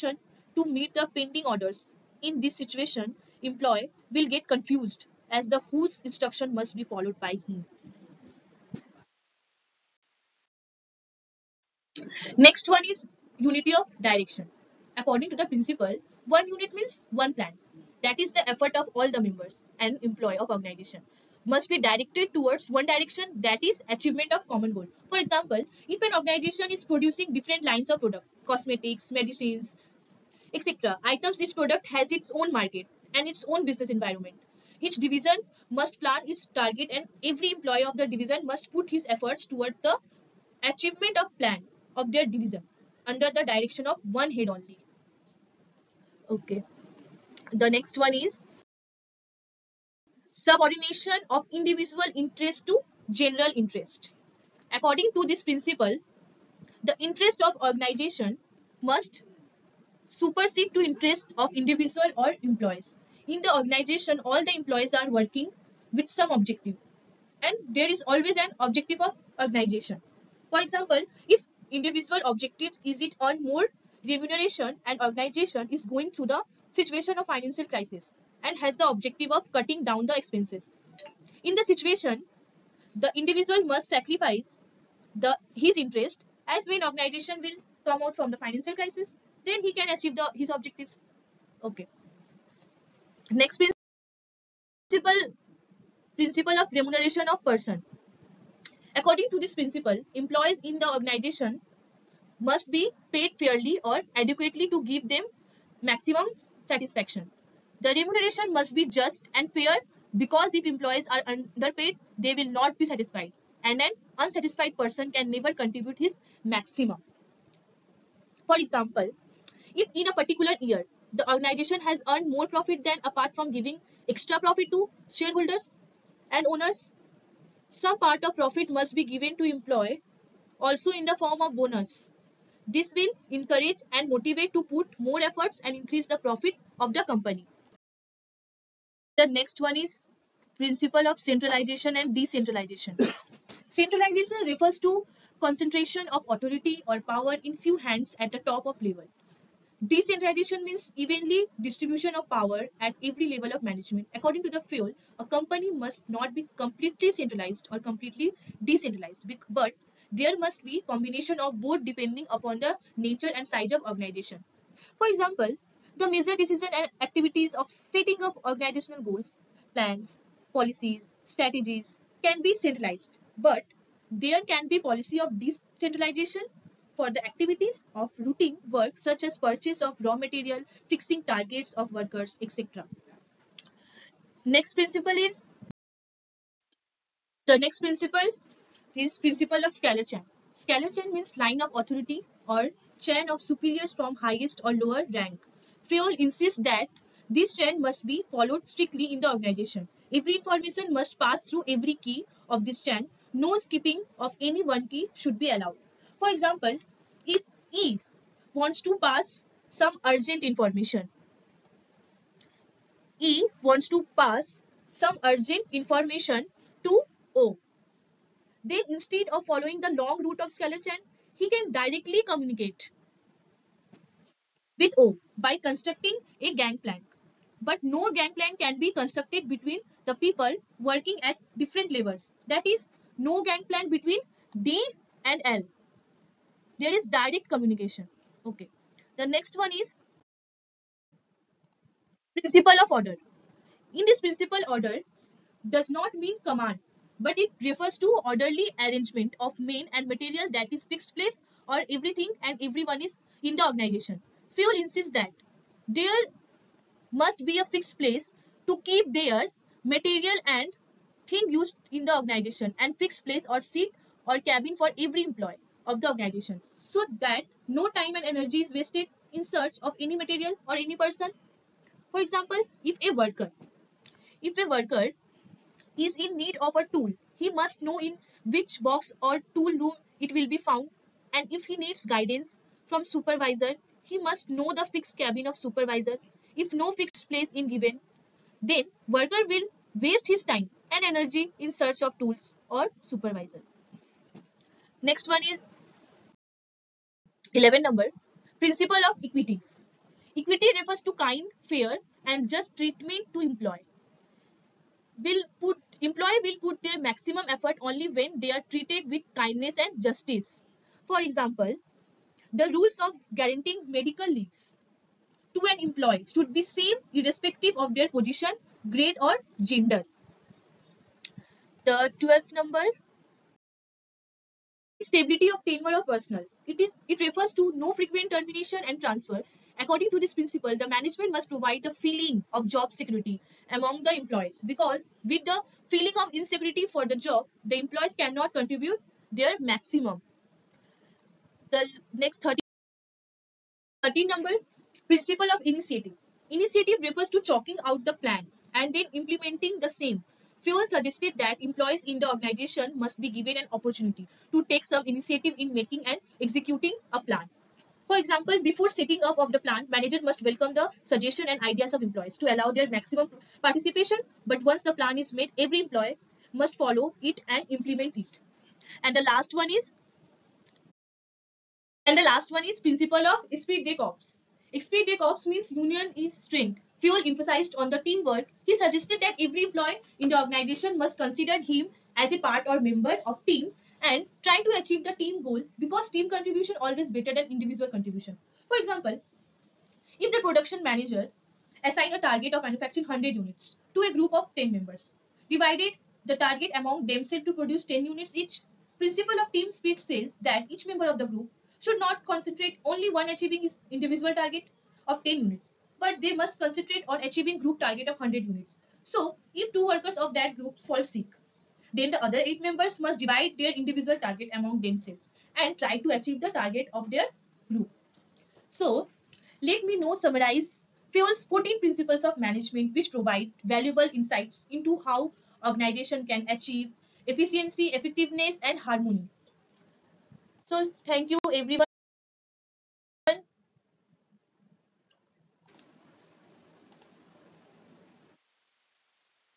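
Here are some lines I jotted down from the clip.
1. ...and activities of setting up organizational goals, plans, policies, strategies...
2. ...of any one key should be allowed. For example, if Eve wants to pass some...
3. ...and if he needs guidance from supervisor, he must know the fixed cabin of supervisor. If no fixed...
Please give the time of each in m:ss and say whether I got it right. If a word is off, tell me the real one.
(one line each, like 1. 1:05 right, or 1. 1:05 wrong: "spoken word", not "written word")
1. 2:46 right
2. 3:24 right
3. 4:41 right.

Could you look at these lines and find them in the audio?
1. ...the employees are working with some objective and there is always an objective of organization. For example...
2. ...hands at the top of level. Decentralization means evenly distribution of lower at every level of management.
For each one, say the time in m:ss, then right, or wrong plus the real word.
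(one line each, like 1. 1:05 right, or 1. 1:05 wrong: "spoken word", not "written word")
1. 1:04 right
2. 2:27 wrong: "power", not "lower".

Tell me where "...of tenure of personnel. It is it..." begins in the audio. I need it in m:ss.
5:25.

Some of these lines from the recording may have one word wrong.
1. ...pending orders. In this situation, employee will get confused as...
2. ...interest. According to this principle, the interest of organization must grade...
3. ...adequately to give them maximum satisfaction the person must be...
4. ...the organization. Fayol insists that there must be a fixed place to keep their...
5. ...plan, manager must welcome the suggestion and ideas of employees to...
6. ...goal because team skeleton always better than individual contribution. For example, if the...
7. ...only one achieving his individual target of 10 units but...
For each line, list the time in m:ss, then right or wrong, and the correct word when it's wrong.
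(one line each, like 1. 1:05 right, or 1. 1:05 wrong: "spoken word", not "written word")
1. 0:01 right
2. 0:53 wrong: "supersede", not "grade"
3. 1:44 wrong: "remuneration", not "person"
4. 4:13 right
5. 5:59 right
6. 6:25 wrong: "contribution", not "skeleton"
7. 6:42 right.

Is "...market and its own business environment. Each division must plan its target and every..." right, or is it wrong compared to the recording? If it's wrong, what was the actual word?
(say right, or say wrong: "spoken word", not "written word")
right.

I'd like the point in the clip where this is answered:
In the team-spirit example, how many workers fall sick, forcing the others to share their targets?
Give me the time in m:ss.
6:49.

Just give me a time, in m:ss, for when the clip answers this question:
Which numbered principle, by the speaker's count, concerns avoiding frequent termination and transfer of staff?
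5:22.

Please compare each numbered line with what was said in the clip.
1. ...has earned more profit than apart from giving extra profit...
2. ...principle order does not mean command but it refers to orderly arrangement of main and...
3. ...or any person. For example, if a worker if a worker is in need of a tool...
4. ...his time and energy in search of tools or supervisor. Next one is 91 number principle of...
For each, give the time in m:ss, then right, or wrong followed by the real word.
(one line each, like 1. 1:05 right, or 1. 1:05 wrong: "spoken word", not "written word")
1. 2:01 right
2. 4:04 right
3. 4:30 right
4. 4:50 wrong: "11", not "91".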